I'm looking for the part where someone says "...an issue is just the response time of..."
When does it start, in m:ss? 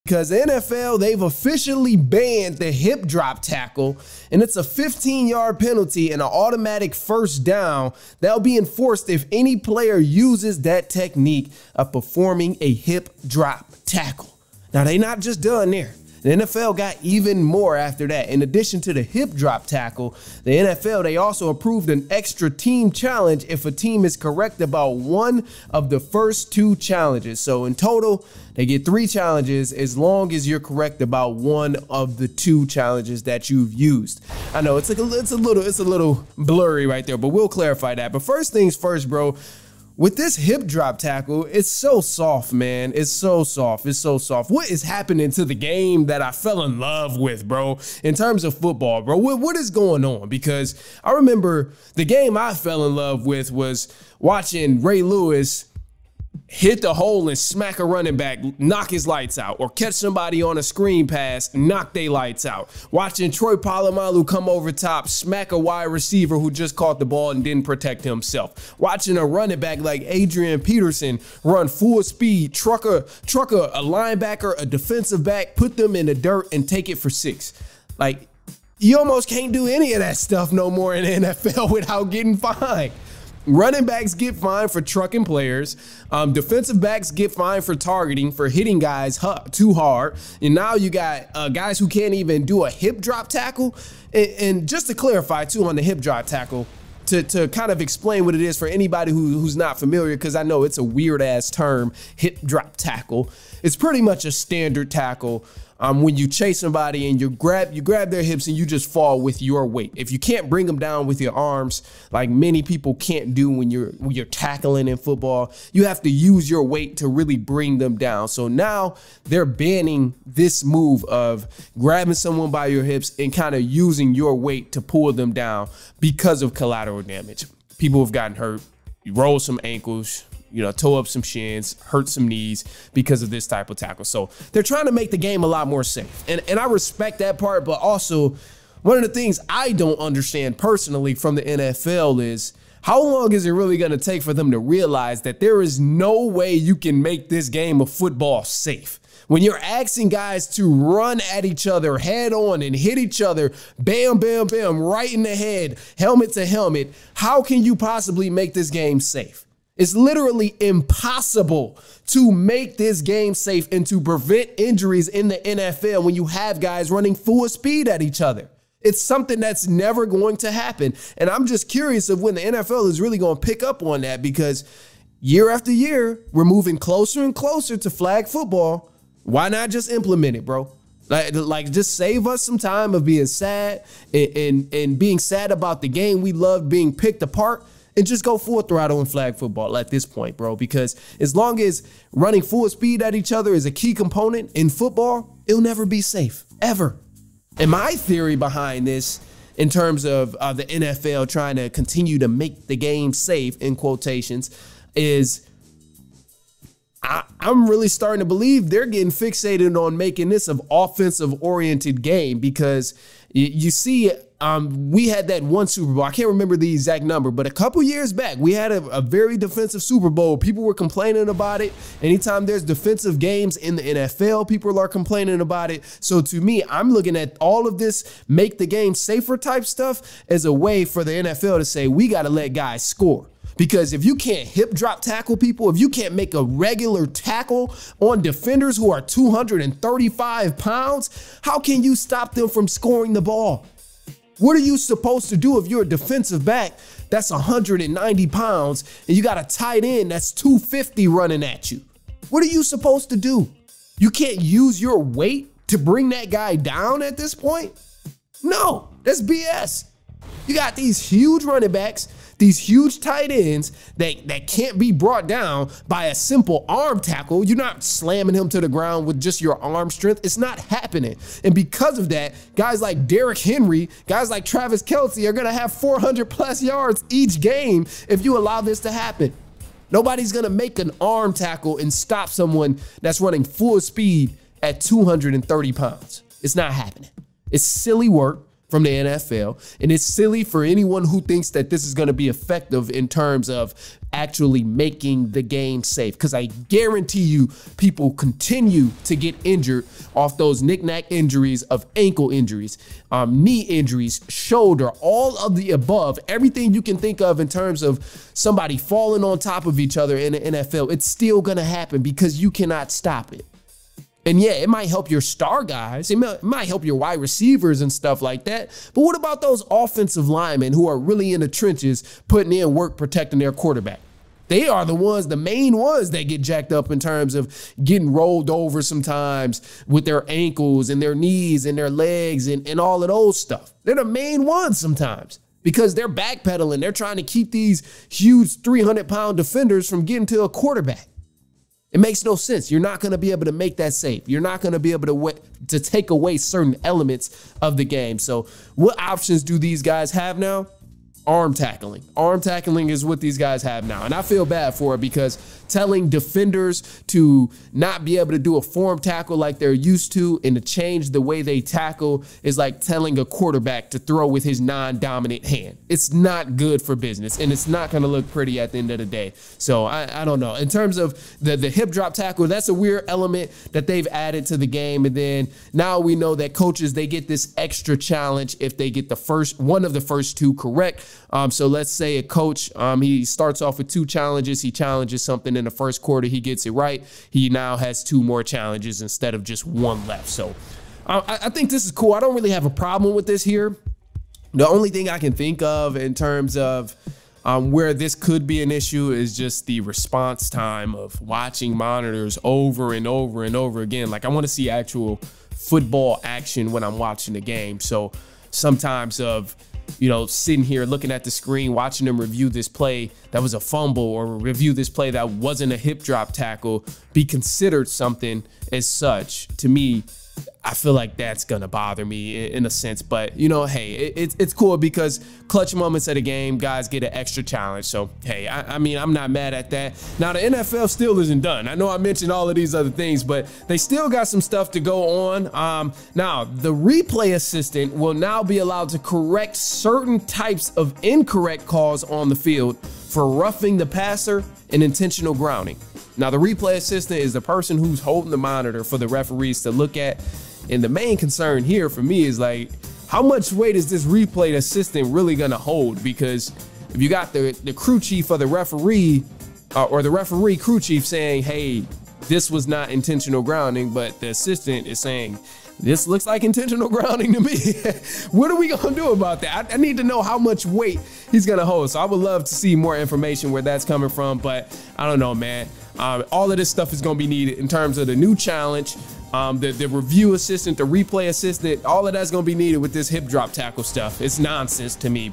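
6:38.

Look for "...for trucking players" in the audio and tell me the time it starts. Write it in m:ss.
1:24.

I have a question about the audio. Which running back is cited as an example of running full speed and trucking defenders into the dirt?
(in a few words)
Adrian Peterson.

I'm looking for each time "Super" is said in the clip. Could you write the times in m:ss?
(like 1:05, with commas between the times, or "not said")
3:35, 3:39.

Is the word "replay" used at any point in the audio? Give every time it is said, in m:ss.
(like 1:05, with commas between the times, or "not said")
7:16, 7:26, 7:34, 8:00.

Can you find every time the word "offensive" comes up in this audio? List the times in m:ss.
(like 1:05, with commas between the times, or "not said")
3:30, 5:19.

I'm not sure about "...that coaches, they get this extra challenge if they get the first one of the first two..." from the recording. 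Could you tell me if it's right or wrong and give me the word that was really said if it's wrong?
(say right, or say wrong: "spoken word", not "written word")
right.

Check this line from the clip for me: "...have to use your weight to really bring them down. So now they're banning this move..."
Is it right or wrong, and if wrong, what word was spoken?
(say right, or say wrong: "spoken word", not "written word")
right.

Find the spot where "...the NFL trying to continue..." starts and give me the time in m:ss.
3:20.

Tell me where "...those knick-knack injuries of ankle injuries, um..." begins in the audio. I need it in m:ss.
5:00.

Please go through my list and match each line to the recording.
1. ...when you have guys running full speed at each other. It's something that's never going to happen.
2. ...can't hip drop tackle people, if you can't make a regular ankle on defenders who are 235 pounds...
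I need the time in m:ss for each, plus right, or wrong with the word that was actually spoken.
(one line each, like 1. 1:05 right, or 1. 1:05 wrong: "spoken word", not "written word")
1. 2:46 right
2. 3:54 wrong: "tackle", not "ankle".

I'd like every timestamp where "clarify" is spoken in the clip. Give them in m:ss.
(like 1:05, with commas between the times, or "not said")
0:37, 1:34.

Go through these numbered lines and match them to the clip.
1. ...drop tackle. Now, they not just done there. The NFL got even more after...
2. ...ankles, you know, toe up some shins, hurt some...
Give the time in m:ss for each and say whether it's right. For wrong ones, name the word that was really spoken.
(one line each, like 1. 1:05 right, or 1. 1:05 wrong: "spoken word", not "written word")
1. 0:13 right
2. 2:09 right.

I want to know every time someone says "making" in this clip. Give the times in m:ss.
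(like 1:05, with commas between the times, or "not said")
3:29, 4:54.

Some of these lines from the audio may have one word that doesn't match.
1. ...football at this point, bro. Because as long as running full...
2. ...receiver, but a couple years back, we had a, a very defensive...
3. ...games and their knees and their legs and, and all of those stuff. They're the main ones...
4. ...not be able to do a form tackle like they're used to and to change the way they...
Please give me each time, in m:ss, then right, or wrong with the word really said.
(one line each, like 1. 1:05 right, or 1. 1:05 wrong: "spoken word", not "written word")
1. 3:09 right
2. 3:37 wrong: "number", not "receiver"
3. 5:30 wrong: "ankles", not "games"
4. 5:57 right.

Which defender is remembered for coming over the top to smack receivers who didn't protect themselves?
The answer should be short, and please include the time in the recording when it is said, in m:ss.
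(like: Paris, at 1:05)
Troy Polamalu, at 1:03.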